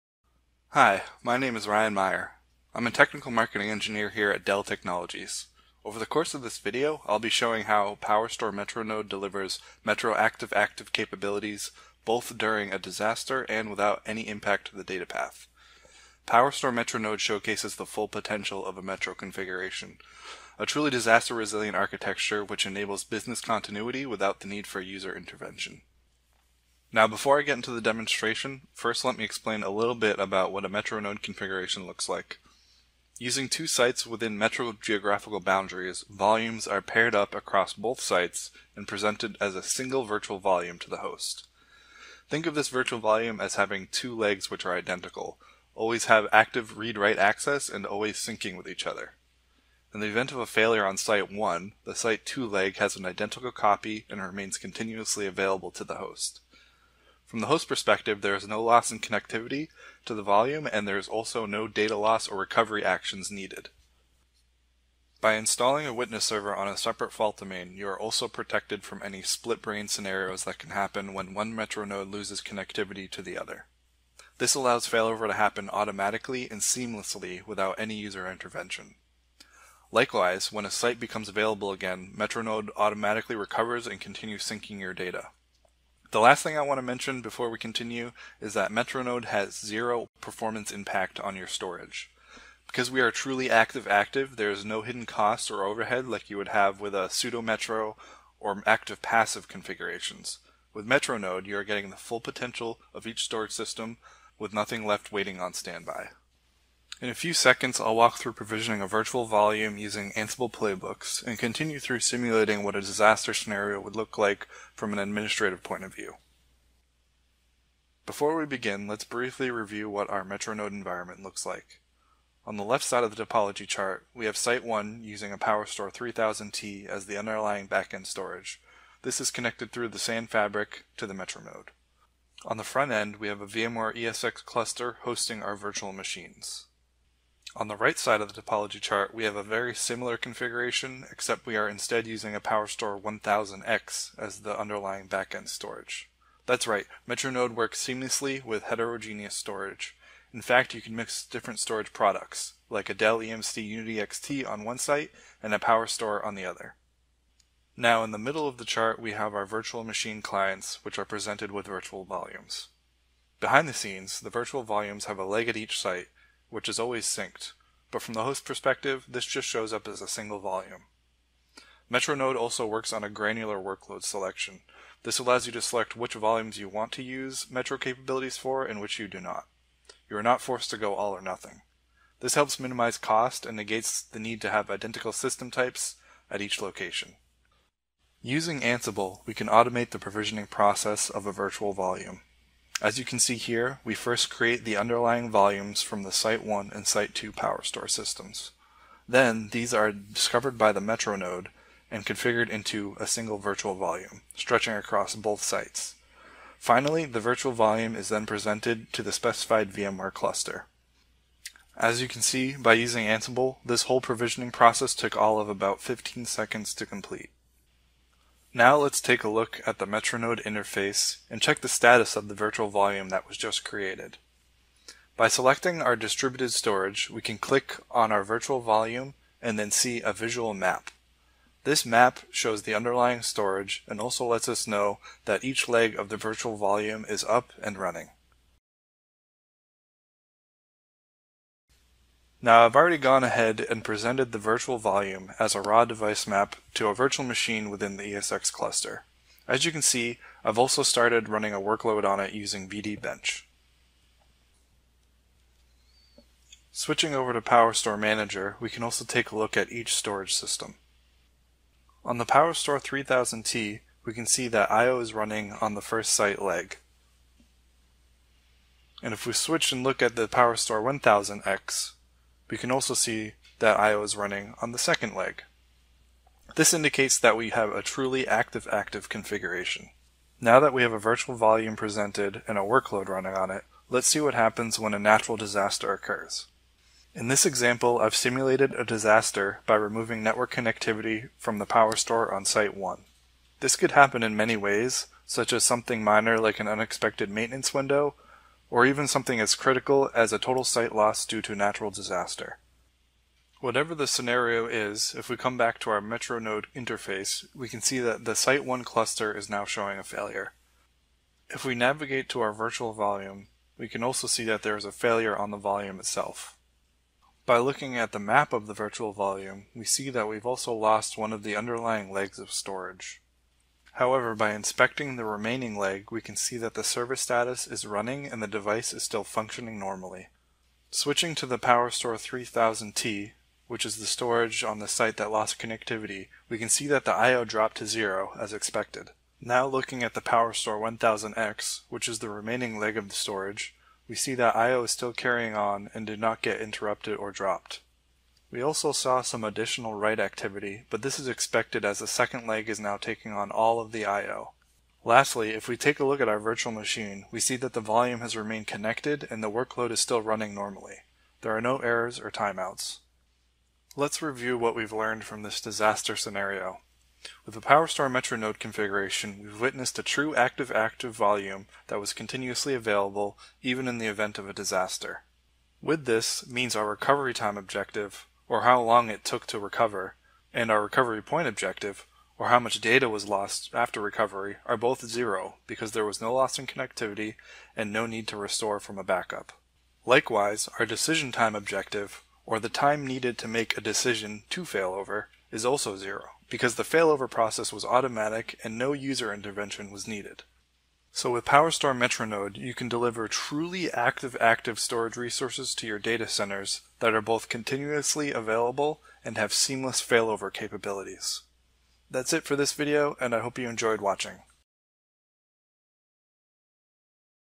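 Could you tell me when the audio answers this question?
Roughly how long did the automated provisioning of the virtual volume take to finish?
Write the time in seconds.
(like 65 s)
215 s.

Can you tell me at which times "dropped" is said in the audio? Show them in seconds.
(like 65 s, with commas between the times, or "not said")
337 s, 347 s.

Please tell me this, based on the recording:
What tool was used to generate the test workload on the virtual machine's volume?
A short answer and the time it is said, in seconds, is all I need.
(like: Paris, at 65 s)
VDBench, at 252 s.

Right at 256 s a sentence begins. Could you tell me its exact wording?
Switching over to PowerStore Manager, we can also take a look at each storage system.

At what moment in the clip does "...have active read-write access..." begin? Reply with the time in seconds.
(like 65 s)
46 s.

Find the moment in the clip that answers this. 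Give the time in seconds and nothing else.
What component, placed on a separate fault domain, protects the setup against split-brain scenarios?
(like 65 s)
65 s.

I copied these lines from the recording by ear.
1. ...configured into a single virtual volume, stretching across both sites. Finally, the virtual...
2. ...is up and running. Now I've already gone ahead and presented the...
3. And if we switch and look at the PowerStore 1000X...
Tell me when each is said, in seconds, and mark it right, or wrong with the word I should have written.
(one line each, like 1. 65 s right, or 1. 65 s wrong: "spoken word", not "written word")
1. 202 s right
2. 237 s right
3. 269 s right.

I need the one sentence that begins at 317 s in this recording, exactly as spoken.
By looking at the map of the virtual volume, we see that we've also lost one of the underlying legs of storage.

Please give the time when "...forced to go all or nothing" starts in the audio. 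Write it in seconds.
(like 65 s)
180 s.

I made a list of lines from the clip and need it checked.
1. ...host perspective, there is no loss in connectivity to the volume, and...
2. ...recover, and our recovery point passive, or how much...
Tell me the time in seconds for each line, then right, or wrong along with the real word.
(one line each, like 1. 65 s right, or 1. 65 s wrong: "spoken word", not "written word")
1. 57 s right
2. 379 s wrong: "objective", not "passive".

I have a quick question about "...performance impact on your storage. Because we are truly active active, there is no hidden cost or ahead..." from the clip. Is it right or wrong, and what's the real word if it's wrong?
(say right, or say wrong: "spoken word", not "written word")
wrong: "overhead", not "ahead".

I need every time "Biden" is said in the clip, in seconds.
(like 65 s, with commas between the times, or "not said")
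not said.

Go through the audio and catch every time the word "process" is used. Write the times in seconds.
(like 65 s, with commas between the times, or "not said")
190 s, 214 s, 397 s.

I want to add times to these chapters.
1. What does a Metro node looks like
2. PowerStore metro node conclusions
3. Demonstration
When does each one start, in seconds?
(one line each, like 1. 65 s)
1. 26 s
2. 365 s
3. 107 s.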